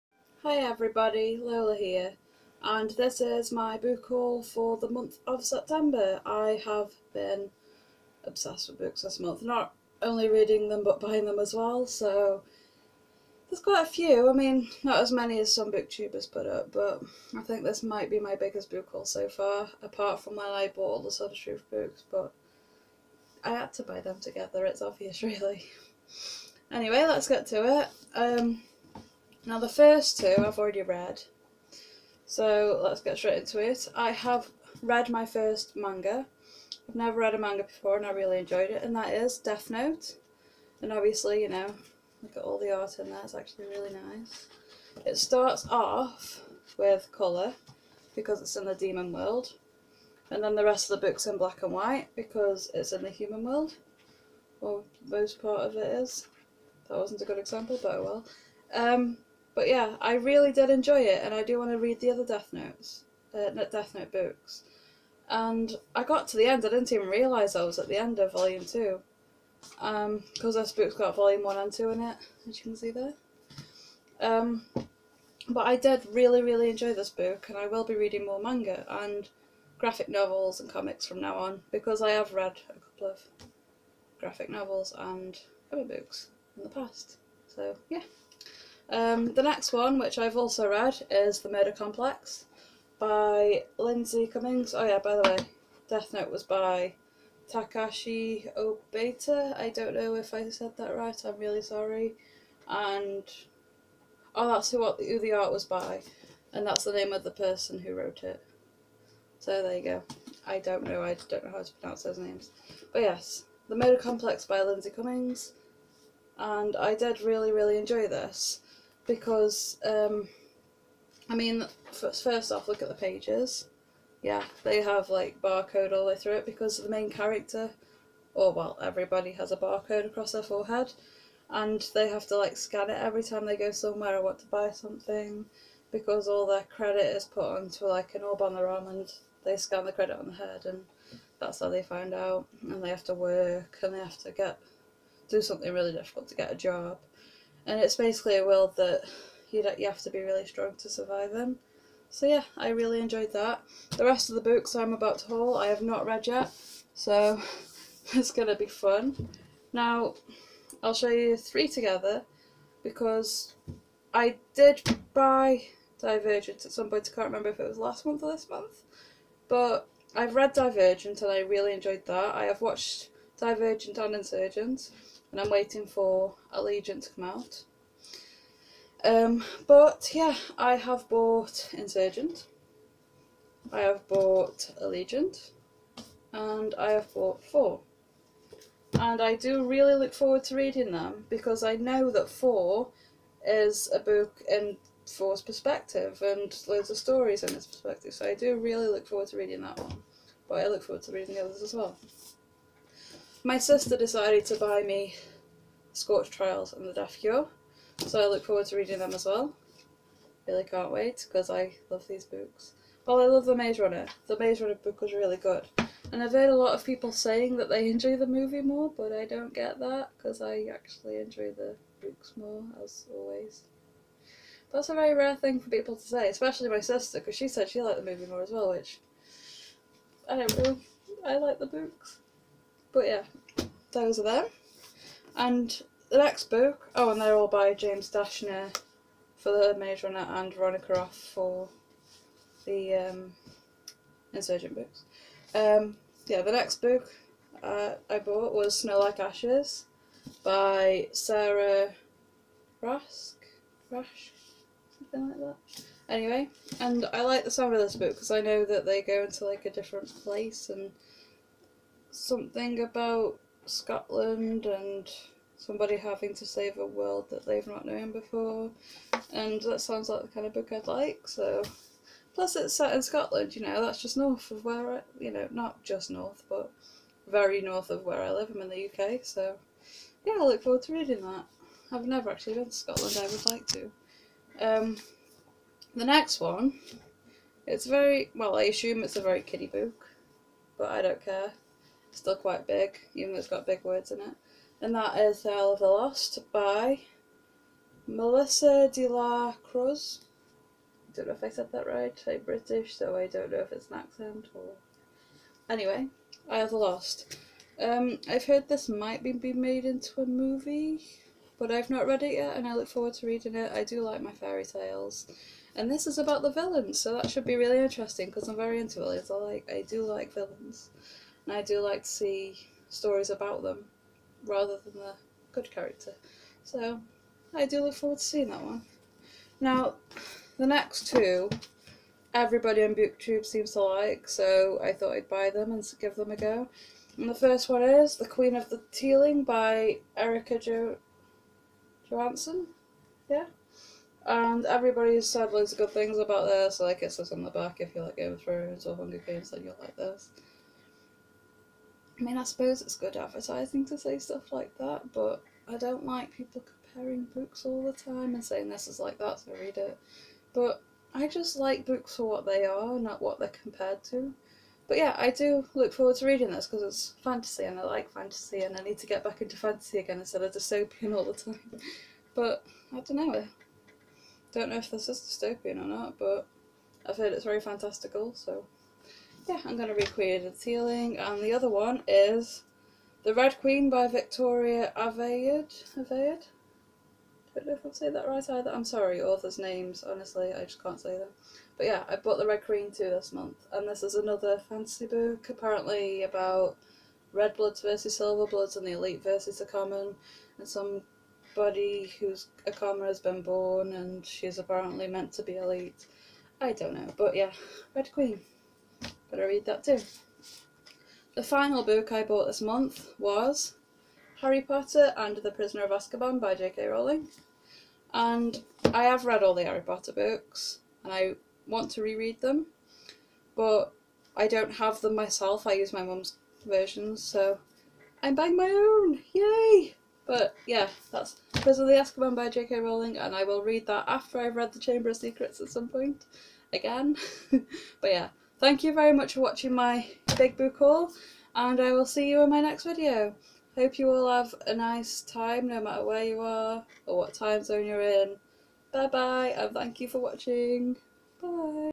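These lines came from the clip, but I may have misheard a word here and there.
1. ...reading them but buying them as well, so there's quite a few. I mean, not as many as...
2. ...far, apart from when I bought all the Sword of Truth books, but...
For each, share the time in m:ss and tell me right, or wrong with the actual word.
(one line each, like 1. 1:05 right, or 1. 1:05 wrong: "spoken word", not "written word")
1. 0:10 right
2. 0:19 right.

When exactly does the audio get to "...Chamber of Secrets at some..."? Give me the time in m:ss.
7:14.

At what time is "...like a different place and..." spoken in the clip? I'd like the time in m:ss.
4:19.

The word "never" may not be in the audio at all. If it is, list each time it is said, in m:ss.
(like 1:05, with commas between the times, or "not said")
0:36, 4:42.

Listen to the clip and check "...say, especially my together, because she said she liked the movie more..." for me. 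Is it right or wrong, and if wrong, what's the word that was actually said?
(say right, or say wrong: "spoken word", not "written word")
wrong: "sister", not "together".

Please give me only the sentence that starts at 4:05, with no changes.
Um, yeah, the next book uh, I bought was Snow Like Ashes by Sarah Rask, Rash, something like that.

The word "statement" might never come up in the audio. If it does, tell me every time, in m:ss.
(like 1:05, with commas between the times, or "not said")
not said.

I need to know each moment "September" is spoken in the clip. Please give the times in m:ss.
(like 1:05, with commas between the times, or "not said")
0:05.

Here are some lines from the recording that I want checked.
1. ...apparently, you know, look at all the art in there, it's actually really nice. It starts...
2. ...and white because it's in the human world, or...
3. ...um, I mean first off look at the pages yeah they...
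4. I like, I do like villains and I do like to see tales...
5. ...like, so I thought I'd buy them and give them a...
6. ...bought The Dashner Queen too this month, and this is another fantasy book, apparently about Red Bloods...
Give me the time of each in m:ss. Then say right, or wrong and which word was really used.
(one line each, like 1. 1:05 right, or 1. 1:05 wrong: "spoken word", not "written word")
1. 0:40 wrong: "obviously", not "apparently"
2. 0:51 right
3. 1:59 right
4. 5:19 wrong: "stories", not "tales"
5. 5:33 right
6. 6:32 wrong: "Red", not "Dashner".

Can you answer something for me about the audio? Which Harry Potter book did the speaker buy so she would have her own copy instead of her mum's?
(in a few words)
Prisoner of Azkaban.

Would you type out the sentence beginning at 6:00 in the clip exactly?
But I just like books for what they are, not what they're compared to.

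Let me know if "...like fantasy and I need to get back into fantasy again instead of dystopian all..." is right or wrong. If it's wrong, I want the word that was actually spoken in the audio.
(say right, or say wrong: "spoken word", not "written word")
right.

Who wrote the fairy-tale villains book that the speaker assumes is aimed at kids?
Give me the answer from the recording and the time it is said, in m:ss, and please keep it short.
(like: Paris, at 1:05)
Melissa de la Cruz, at 4:58.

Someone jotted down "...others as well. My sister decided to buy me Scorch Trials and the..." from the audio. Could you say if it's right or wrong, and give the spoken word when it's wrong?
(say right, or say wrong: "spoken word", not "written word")
right.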